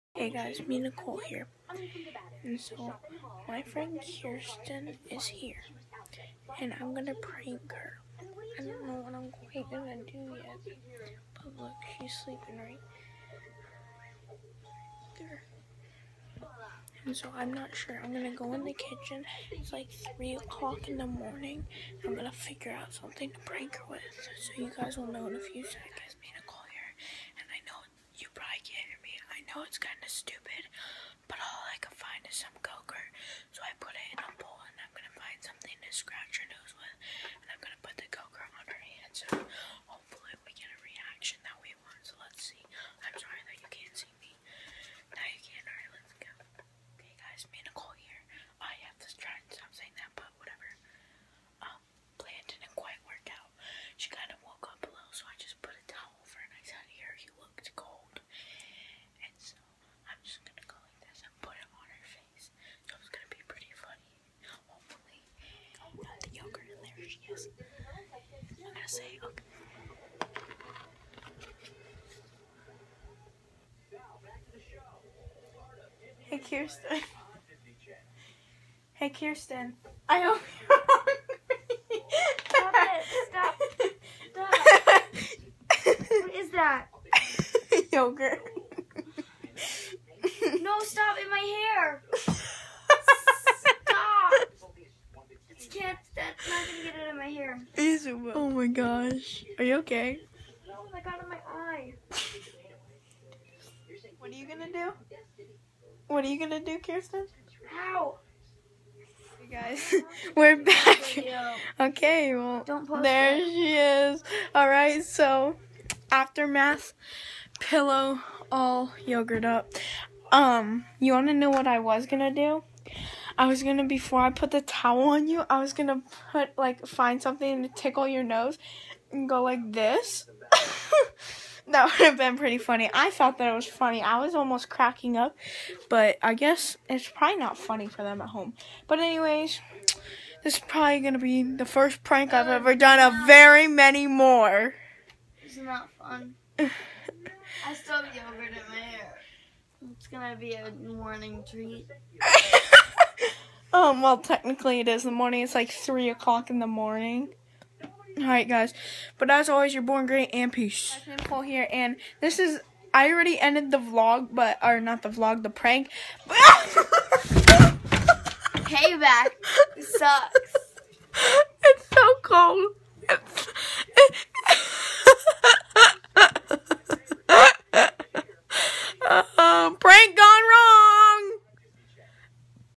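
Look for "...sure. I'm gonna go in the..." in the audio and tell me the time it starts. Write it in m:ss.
0:17.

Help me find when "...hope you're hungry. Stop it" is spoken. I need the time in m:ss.
1:20.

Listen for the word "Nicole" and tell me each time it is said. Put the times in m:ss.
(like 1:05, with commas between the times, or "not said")
0:00, 2:41.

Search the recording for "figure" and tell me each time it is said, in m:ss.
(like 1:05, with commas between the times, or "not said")
0:22.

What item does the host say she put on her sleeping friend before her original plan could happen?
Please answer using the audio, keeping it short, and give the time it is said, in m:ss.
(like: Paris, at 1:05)
Towel, at 2:04.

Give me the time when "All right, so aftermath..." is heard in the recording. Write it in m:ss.
1:54.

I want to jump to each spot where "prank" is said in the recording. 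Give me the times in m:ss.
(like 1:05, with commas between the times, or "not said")
0:07, 0:23, 2:22, 2:45.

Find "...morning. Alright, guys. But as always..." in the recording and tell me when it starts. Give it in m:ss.
2:36.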